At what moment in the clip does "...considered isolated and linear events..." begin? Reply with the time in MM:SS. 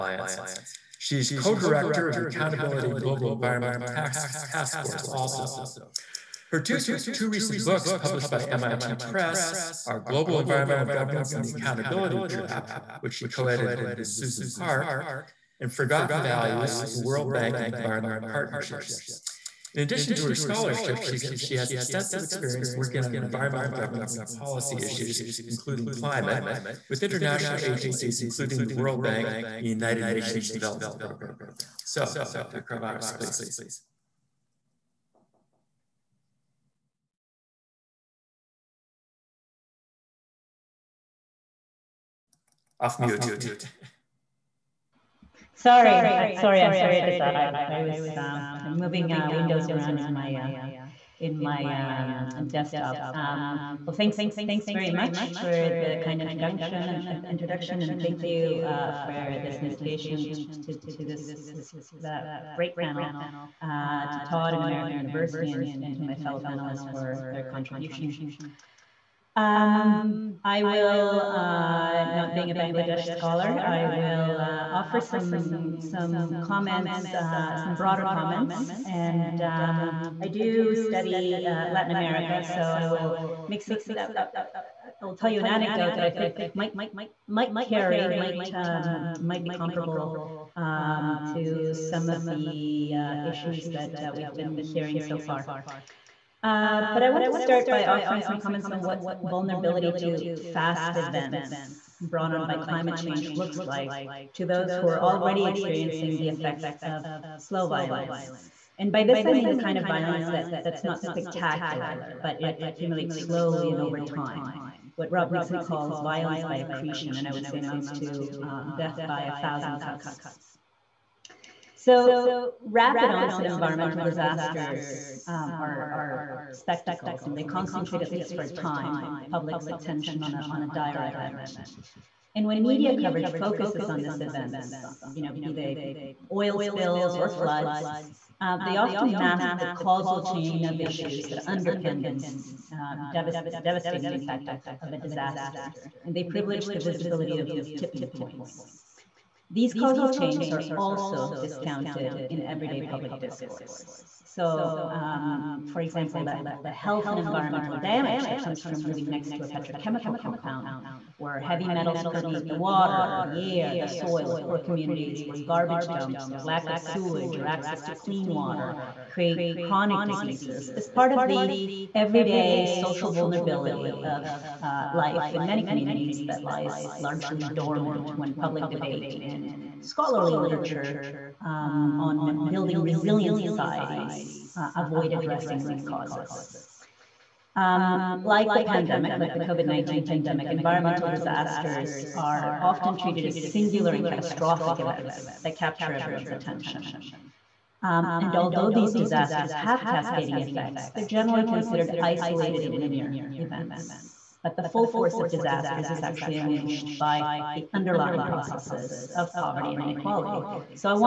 03:21.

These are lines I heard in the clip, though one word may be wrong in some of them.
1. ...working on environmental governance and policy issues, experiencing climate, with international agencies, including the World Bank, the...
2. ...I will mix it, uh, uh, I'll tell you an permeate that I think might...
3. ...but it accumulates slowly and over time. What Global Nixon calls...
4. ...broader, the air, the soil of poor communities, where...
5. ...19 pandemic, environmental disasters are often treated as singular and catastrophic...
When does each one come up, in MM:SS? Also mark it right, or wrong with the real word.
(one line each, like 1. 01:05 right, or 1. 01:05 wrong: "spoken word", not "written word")
1. 00:22 wrong: "including", not "experiencing"
2. 01:22 wrong: "anecdote", not "permeate"
3. 01:52 wrong: "Rob", not "Global"
4. 02:42 wrong: "water", not "broader"
5. 03:09 right.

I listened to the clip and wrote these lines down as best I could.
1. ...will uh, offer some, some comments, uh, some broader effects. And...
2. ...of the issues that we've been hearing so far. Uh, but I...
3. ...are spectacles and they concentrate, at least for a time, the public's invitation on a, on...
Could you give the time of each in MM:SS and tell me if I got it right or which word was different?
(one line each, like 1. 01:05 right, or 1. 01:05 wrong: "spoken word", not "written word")
1. 01:13 wrong: "comments", not "effects"
2. 01:32 right
3. 02:05 wrong: "attention", not "invitation".